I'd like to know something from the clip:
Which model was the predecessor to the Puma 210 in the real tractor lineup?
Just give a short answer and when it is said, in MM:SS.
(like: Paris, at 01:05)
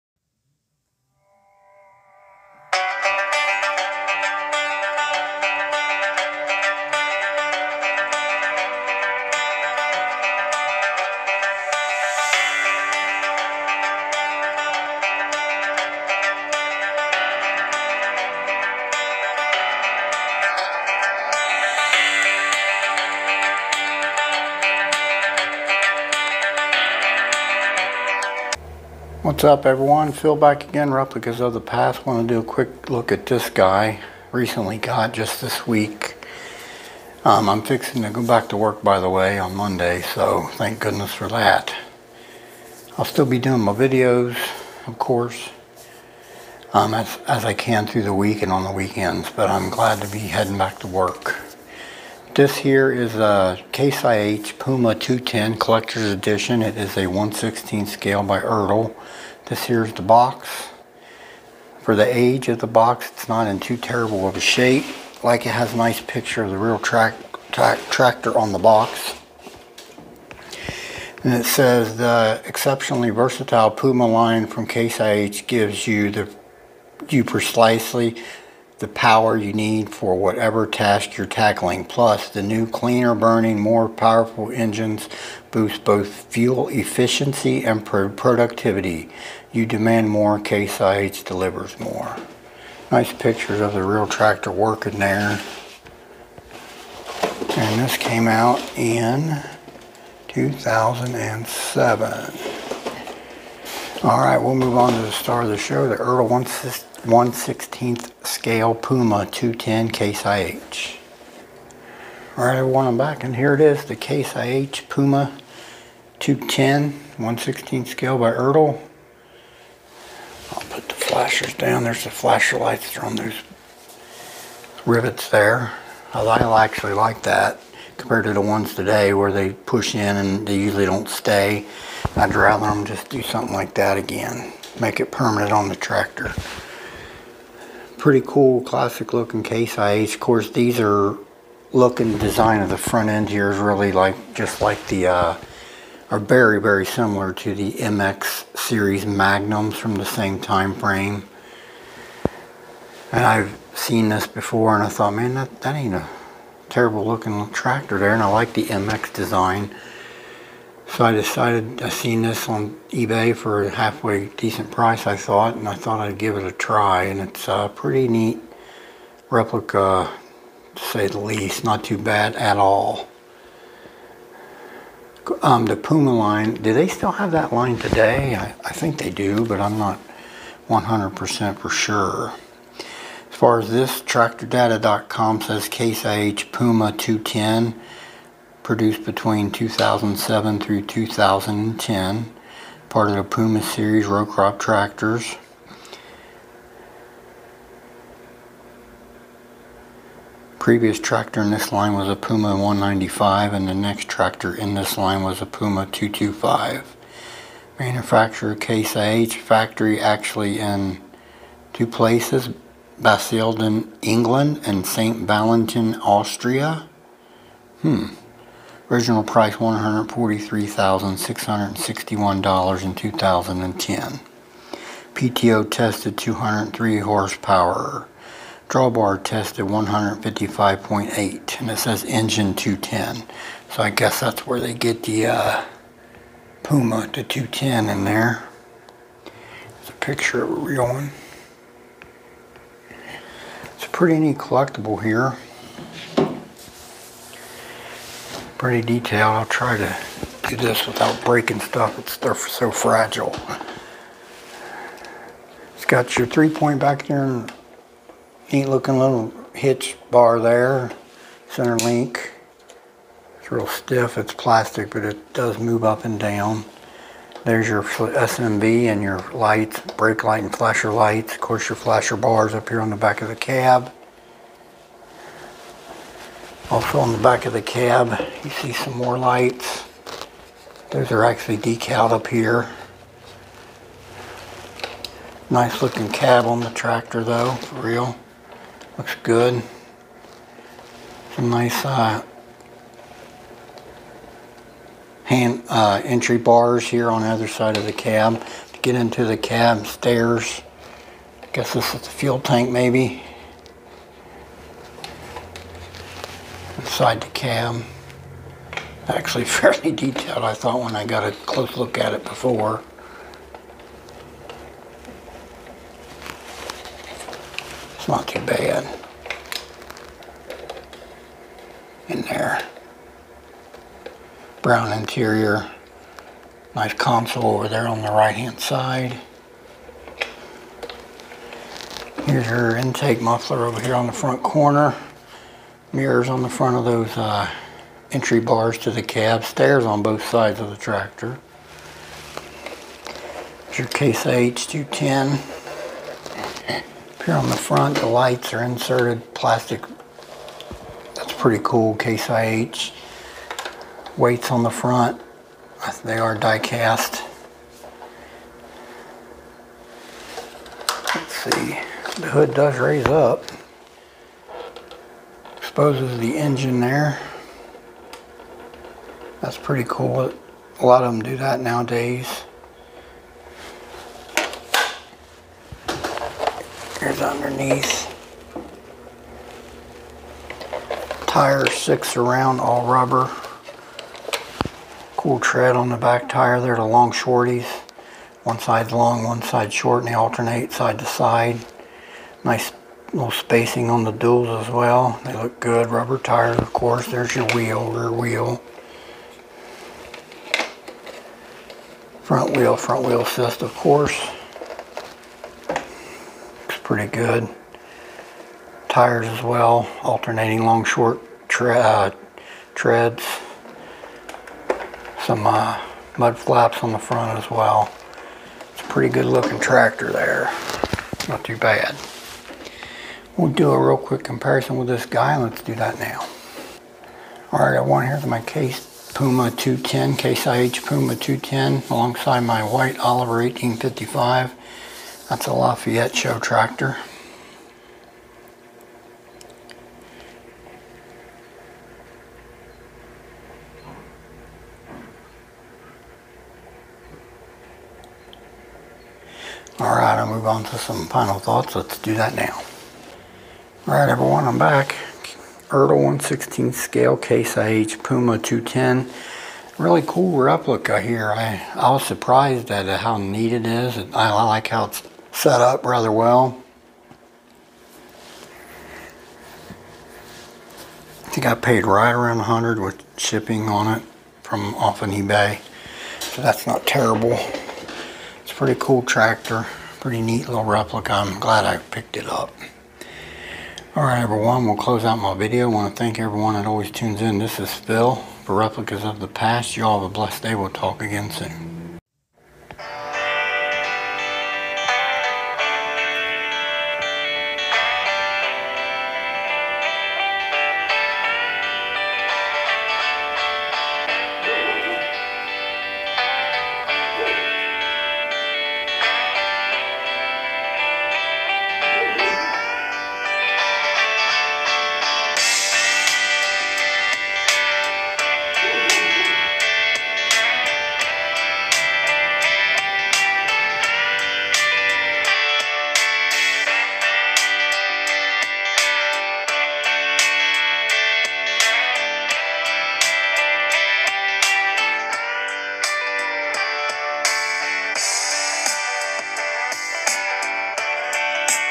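Puma 195, at 03:22.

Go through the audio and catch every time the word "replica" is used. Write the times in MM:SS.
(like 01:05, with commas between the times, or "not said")
00:30, 02:49, 07:40, 08:00, 08:08.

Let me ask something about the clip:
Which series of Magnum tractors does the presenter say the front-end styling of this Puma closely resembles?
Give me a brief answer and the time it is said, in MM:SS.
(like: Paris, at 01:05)
MX series, at 02:27.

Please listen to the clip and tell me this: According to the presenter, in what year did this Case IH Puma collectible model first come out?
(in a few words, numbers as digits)
2007.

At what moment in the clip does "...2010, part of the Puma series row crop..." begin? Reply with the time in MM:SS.
03:10.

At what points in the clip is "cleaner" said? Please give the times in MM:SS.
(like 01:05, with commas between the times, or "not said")
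01:22.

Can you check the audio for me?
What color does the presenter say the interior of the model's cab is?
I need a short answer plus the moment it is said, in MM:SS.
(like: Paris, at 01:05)
Brown, at 05:24.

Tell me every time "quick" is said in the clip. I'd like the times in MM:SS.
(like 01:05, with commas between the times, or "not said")
00:32, 07:03.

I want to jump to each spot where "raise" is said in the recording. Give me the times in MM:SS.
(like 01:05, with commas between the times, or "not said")
06:02.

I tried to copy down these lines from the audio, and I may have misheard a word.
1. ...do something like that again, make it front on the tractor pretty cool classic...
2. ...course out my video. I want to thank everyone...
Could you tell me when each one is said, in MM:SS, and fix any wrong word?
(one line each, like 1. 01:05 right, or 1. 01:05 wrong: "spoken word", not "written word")
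1. 02:13 wrong: "permanent", not "front"
2. 08:04 wrong: "close", not "course".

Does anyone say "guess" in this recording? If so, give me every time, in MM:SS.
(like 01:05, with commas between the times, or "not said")
03:53, 05:01.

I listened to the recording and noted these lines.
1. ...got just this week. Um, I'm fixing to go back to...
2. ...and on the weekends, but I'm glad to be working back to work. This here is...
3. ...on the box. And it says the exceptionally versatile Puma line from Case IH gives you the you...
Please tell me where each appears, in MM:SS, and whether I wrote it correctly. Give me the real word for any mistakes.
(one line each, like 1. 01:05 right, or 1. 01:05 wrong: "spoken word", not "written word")
1. 00:34 right
2. 00:48 wrong: "heading", not "working"
3. 01:08 right.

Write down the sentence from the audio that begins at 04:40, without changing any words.
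Those are actually decaled up here.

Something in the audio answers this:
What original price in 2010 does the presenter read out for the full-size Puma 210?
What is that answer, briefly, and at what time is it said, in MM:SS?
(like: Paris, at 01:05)
$143,661, at 03:39.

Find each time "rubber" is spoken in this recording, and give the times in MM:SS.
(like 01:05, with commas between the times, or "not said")
06:22, 06:35.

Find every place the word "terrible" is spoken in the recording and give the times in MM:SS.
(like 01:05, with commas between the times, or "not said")
01:03, 02:36, 07:56.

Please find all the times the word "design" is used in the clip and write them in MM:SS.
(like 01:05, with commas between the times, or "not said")
02:22, 02:39.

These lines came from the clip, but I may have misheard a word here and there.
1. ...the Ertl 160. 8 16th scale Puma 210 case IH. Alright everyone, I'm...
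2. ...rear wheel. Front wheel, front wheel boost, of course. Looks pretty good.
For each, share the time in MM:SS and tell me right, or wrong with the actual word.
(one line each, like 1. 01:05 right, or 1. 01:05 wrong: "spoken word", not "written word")
1. 01:45 wrong: "1", not "8"
2. 06:37 wrong: "assist", not "boost".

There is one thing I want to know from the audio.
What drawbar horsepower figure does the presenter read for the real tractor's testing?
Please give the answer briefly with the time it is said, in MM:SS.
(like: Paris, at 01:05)
155.8, at 03:49.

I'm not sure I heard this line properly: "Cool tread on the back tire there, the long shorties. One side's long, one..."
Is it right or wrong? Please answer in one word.
right.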